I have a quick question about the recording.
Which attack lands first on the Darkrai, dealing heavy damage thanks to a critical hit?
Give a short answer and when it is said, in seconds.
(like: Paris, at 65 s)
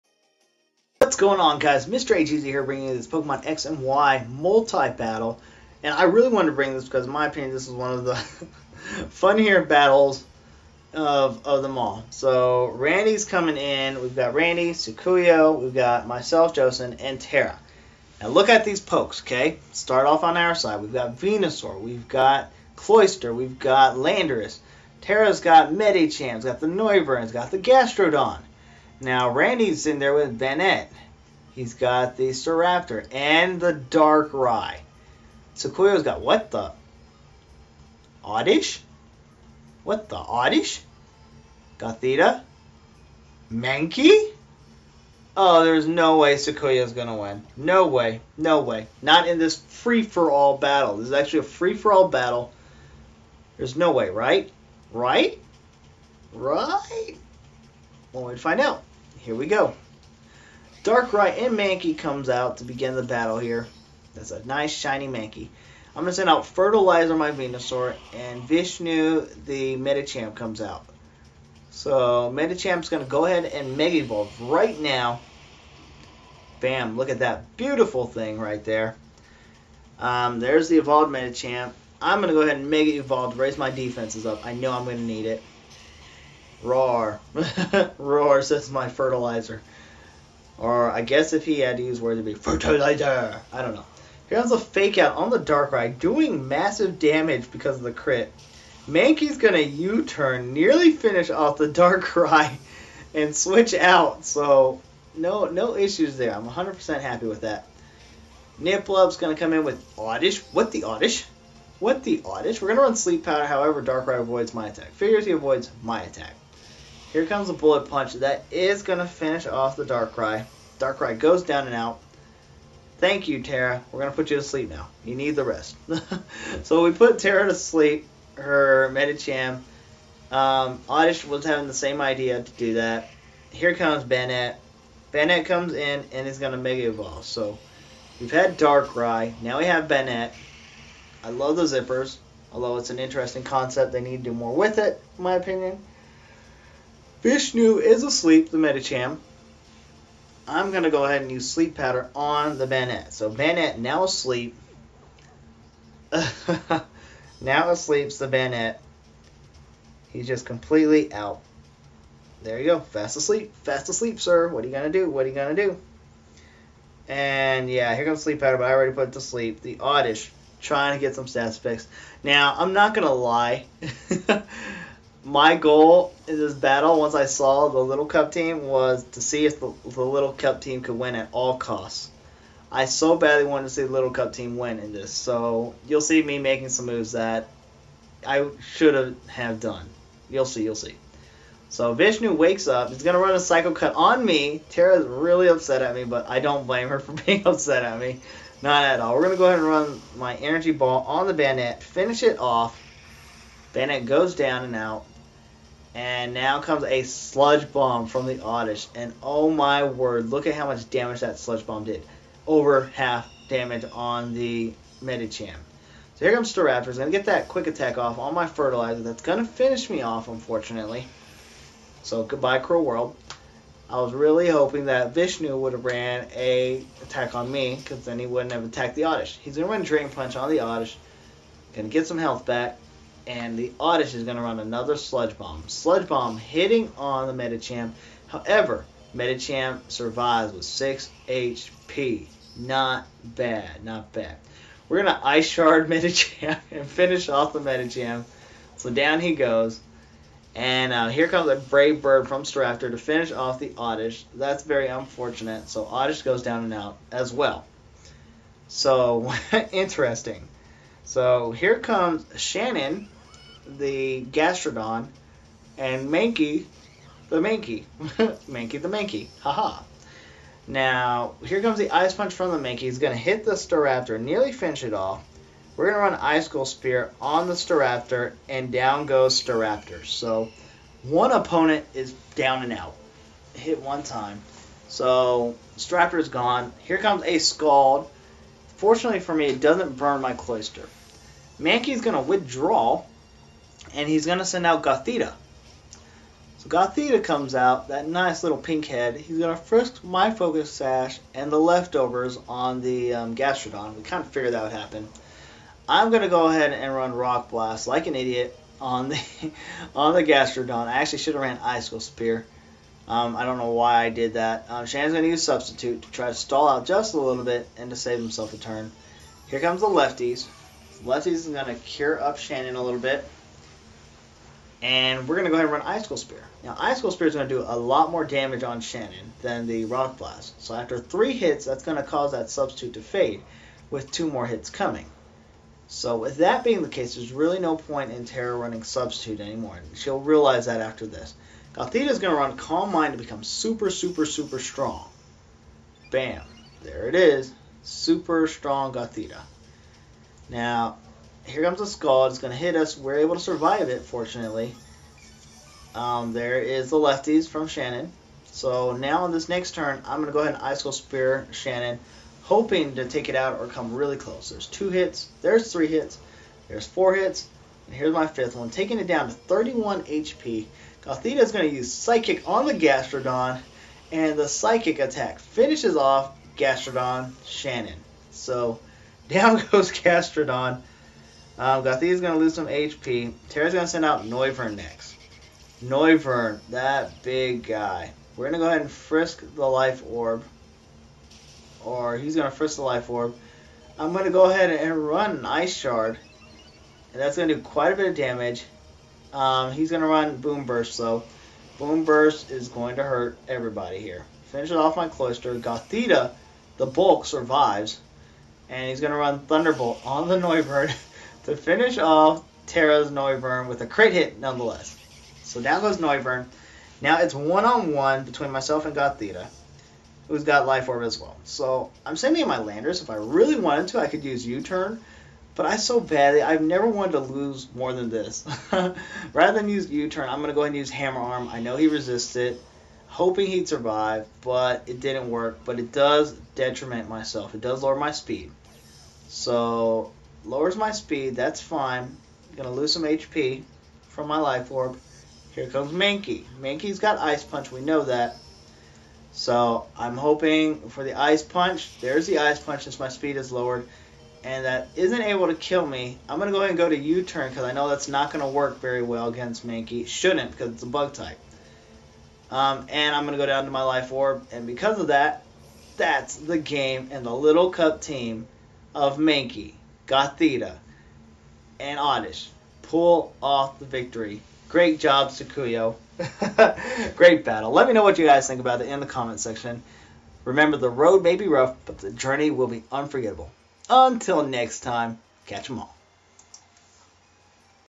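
Fake Out, at 94 s.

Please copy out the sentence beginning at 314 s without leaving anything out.
Um, going to use Substitute to try to stall out just a little bit and to save himself a turn.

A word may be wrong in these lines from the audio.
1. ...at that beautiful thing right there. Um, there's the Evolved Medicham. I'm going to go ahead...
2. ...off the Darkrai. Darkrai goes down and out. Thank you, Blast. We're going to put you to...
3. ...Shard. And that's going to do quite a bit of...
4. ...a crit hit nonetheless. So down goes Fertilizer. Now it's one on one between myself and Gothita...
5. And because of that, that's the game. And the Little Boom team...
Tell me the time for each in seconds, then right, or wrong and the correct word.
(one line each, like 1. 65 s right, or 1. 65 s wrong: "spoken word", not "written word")
1. 77 s right
2. 119 s wrong: "Tara", not "Blast"
3. 395 s right
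4. 413 s wrong: "Noivern", not "Fertilizer"
5. 464 s wrong: "Cup", not "Boom".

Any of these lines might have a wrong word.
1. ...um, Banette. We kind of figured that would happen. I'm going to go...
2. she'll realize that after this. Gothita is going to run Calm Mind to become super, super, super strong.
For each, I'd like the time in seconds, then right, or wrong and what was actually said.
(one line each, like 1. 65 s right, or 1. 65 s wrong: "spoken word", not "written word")
1. 303 s wrong: "Gastrodon", not "Banette"
2. 339 s right.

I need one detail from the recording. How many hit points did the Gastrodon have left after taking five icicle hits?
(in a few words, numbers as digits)
31.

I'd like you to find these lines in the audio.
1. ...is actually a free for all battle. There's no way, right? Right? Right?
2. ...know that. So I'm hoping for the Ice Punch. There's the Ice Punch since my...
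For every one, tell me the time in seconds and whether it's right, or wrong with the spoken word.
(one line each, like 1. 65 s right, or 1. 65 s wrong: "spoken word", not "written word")
1. 51 s right
2. 447 s right.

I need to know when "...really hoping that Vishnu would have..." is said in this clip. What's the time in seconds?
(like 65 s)
224 s.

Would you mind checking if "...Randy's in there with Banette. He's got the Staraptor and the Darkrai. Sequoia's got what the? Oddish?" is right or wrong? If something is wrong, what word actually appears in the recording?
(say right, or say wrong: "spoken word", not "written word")
right.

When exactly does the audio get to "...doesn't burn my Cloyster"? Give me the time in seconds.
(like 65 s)
289 s.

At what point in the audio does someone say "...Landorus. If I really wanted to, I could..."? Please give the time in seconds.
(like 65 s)
422 s.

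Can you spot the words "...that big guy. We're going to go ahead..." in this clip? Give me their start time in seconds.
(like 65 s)
386 s.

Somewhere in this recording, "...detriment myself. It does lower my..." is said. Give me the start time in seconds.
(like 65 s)
436 s.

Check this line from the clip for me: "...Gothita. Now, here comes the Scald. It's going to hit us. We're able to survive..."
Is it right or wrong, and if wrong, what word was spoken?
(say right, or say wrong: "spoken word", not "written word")
right.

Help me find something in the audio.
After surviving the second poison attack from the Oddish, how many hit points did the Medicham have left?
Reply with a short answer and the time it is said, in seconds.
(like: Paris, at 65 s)
6, at 240 s.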